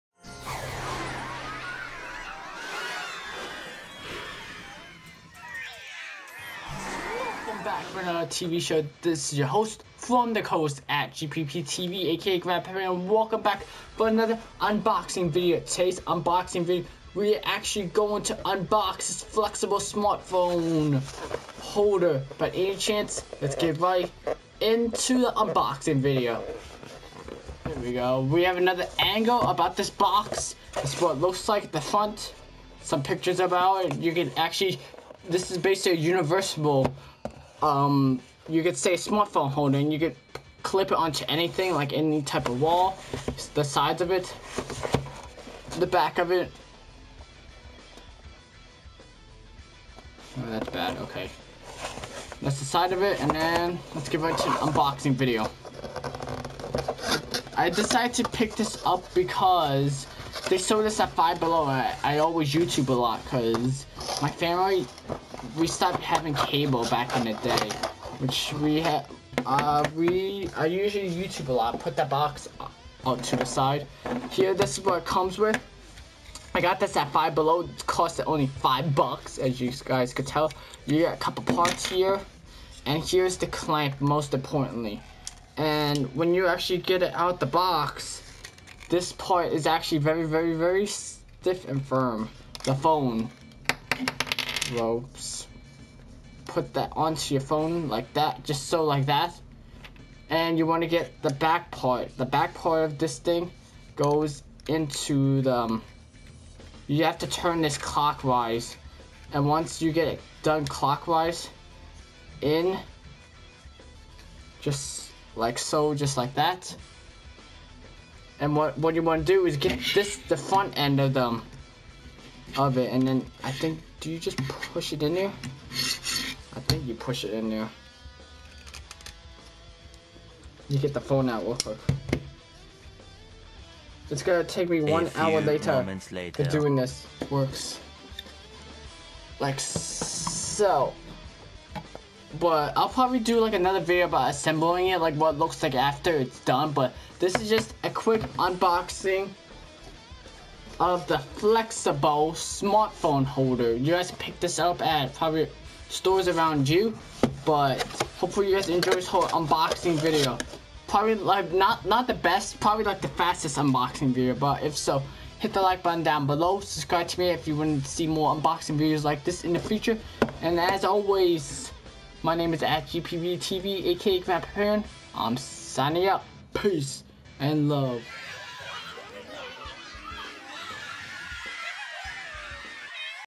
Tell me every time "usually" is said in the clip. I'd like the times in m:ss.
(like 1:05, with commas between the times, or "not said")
1:10.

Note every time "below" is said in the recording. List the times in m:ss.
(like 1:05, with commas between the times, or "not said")
1:01, 1:17, 2:46.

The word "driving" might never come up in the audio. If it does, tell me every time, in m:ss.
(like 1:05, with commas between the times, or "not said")
not said.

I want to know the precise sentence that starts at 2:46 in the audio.
Subscribe to me if you want to see more unboxing videos like this in the future.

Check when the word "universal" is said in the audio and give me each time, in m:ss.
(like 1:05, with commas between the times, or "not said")
0:36.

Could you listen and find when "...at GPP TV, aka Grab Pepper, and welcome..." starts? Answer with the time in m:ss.
0:10.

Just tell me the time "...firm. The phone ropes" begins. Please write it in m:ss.
1:31.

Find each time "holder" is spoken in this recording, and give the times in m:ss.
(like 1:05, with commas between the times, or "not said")
0:21, 0:39, 2:33.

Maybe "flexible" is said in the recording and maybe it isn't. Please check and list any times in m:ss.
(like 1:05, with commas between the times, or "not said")
0:19, 2:31.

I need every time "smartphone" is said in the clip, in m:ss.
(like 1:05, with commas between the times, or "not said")
0:19, 0:38, 2:32.